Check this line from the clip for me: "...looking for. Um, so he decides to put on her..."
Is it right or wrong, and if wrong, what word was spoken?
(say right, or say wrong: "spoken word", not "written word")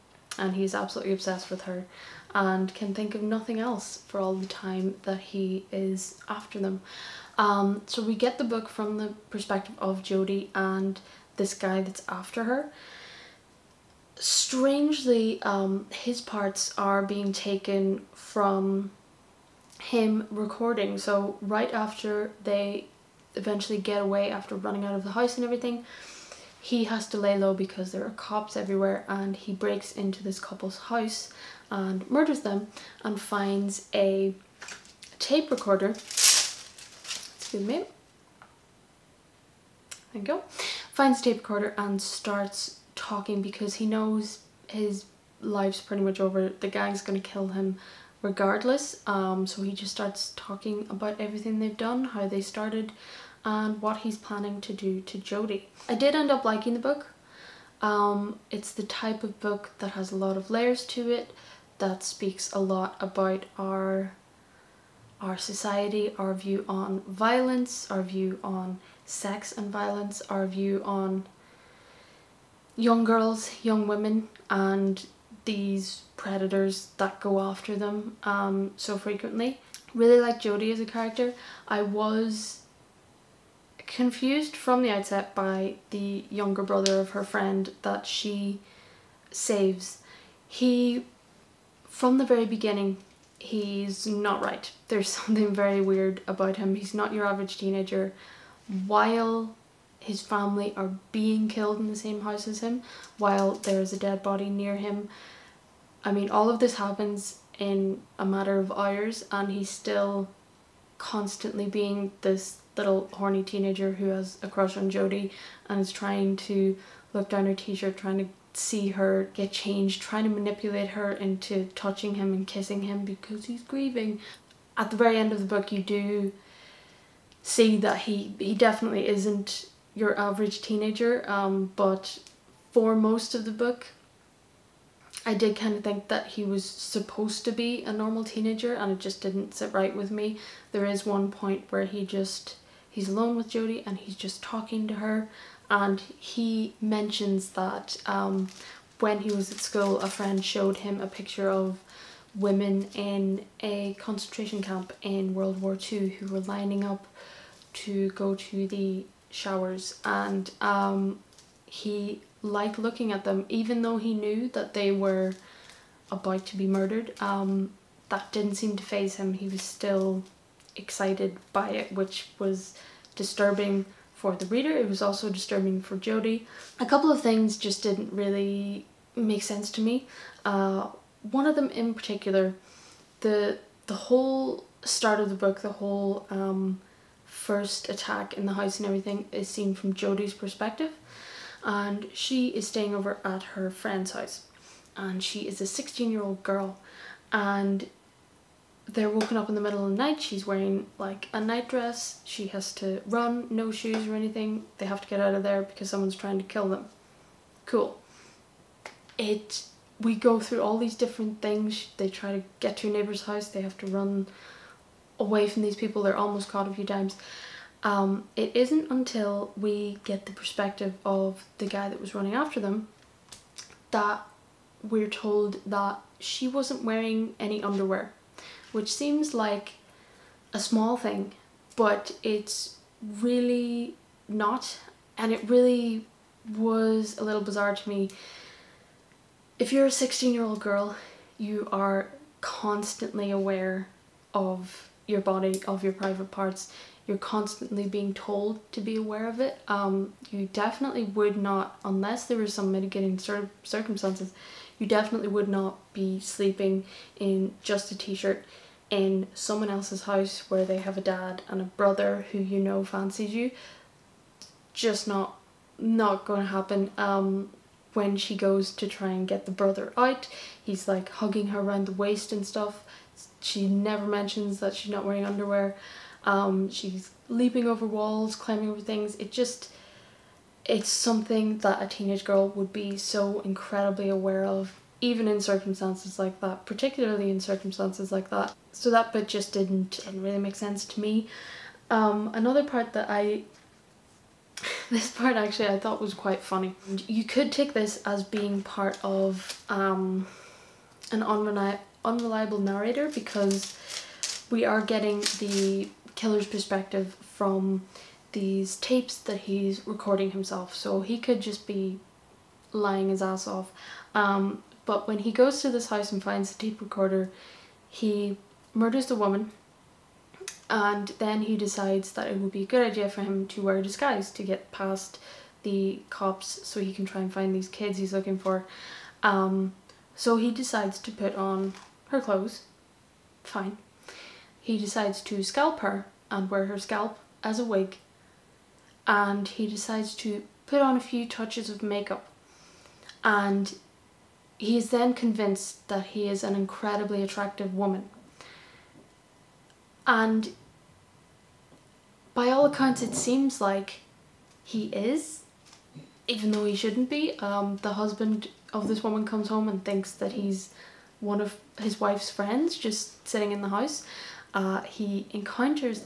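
right.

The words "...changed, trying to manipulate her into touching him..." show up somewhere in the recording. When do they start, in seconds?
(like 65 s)
119 s.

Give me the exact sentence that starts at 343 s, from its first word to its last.
And he is then convinced that he is an incredibly attractive woman.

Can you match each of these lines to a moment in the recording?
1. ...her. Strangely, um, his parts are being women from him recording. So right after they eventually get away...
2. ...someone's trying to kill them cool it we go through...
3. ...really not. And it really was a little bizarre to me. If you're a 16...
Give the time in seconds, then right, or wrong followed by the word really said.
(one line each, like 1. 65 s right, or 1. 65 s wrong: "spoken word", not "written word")
1. 12 s wrong: "taken", not "women"
2. 205 s right
3. 233 s right.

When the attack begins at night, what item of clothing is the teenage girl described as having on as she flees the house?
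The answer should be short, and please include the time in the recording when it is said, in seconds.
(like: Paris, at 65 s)
nightdress, at 201 s.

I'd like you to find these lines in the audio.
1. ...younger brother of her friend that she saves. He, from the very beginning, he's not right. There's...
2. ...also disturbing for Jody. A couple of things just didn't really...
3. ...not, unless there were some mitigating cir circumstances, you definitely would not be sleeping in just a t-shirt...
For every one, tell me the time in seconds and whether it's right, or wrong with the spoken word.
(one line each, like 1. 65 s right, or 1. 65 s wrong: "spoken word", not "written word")
1. 86 s right
2. 175 s right
3. 251 s right.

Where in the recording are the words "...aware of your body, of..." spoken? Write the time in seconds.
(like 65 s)
243 s.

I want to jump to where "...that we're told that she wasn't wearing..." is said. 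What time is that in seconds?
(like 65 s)
223 s.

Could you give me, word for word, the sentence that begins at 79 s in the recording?
Really like Jody as a character.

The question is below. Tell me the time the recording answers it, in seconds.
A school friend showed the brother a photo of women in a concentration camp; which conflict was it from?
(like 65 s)
155 s.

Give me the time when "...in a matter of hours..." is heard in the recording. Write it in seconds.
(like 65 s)
107 s.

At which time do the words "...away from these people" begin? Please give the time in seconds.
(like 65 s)
215 s.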